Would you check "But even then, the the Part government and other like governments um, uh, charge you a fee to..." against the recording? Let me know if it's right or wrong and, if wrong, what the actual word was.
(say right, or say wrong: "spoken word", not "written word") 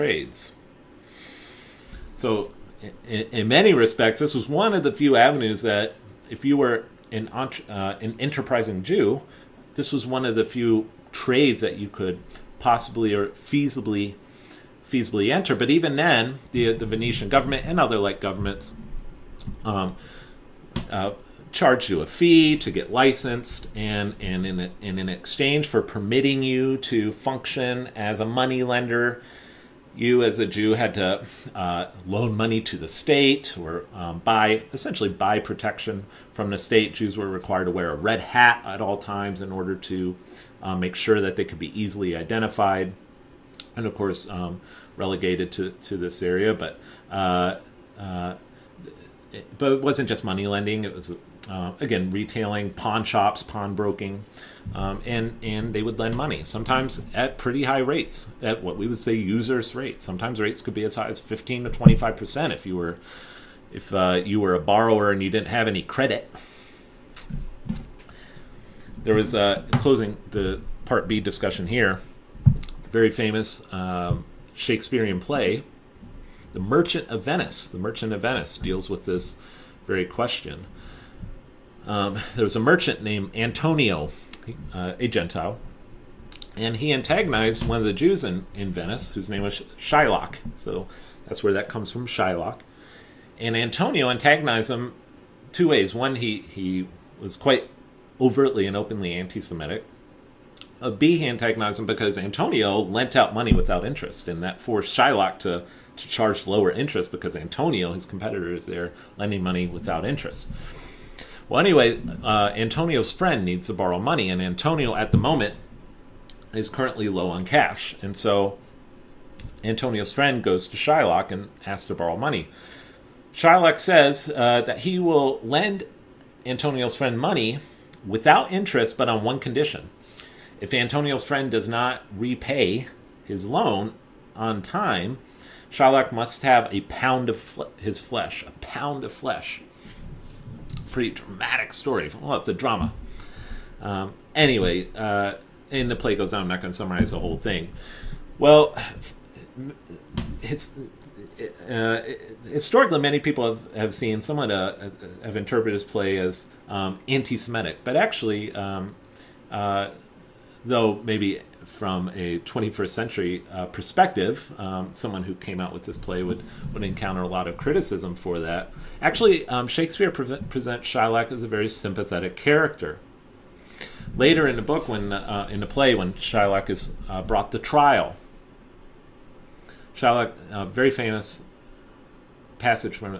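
wrong: "Venetian", not "Part".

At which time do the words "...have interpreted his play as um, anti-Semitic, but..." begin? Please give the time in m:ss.
2:35.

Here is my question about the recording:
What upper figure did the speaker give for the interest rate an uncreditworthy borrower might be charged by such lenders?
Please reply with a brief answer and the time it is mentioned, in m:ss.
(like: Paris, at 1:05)
25 percent, at 1:01.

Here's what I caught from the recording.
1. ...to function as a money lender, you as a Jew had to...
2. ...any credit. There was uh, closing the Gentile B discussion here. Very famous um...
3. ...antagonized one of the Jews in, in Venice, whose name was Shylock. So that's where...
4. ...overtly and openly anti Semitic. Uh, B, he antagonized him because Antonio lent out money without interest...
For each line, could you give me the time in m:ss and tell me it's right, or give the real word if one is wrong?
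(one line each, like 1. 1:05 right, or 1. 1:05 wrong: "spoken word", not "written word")
1. 0:26 right
2. 1:05 wrong: "Part", not "Gentile"
3. 1:26 right
4. 1:38 right.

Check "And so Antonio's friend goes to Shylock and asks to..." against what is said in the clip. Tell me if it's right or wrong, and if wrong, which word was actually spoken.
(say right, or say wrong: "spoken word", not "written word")
right.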